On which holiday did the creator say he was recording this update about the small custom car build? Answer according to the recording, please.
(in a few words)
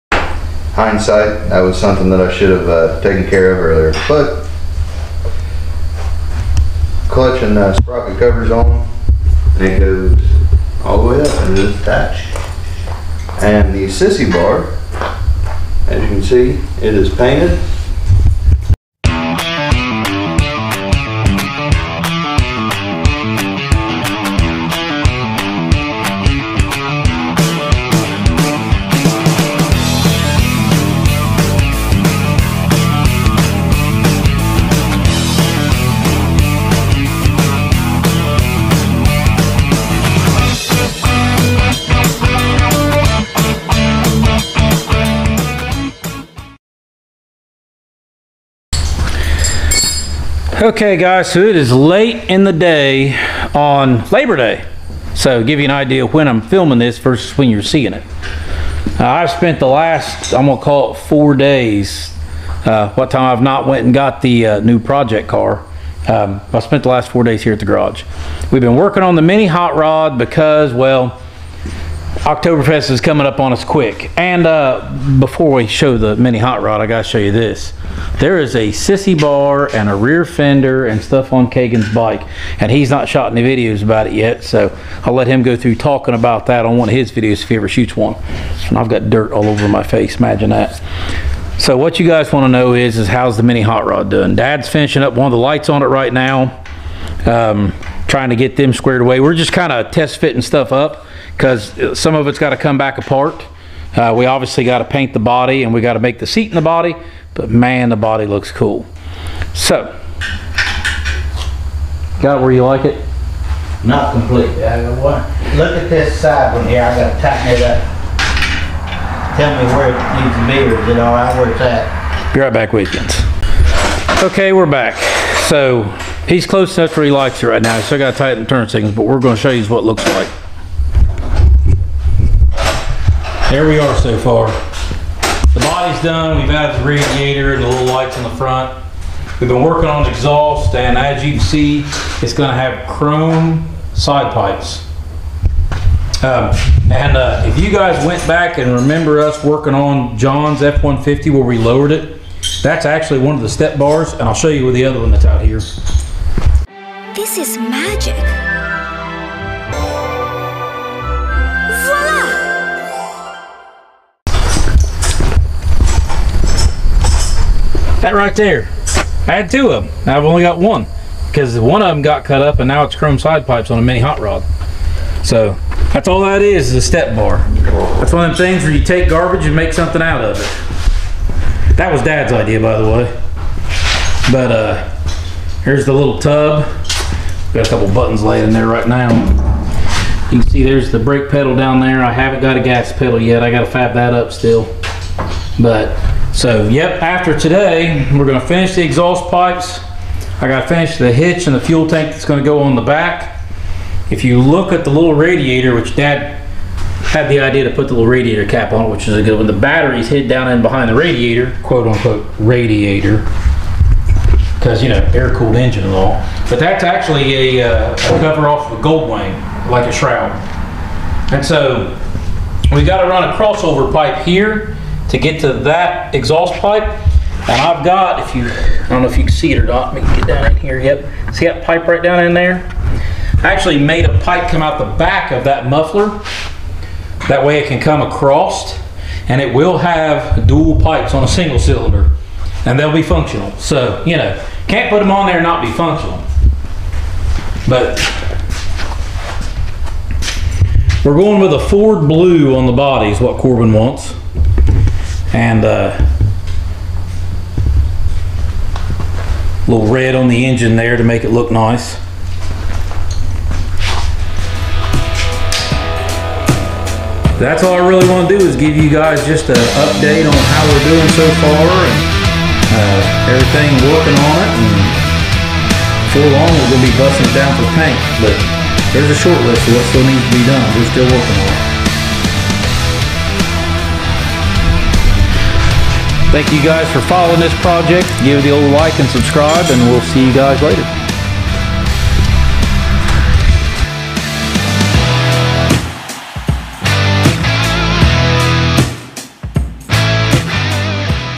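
Labor Day.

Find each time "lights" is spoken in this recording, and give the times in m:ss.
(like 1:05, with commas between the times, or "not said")
1:35, 2:17.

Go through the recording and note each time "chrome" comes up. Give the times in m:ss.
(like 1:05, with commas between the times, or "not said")
2:22, 2:52.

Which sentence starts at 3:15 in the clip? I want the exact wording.
But so, yep, after today, we're gonna finish the exhaust pipes.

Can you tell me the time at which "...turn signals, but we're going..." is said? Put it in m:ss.
2:08.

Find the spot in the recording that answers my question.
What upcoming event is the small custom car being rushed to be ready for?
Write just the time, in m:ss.
1:12.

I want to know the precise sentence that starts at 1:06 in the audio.
Um, I spent the last four days here at the garage.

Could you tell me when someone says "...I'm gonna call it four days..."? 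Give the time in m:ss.
1:00.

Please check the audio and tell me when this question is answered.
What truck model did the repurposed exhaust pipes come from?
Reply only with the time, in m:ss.
2:30.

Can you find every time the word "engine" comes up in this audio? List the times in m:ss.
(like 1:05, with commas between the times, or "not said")
3:35, 4:20.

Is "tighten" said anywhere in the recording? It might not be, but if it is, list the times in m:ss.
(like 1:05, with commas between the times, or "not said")
1:57, 2:08.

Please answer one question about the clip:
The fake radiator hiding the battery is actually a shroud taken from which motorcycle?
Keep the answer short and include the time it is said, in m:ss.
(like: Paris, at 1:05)
Gold Wing, at 3:38.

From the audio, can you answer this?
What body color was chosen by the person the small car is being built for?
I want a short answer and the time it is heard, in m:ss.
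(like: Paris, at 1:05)
Ford Blue, at 4:11.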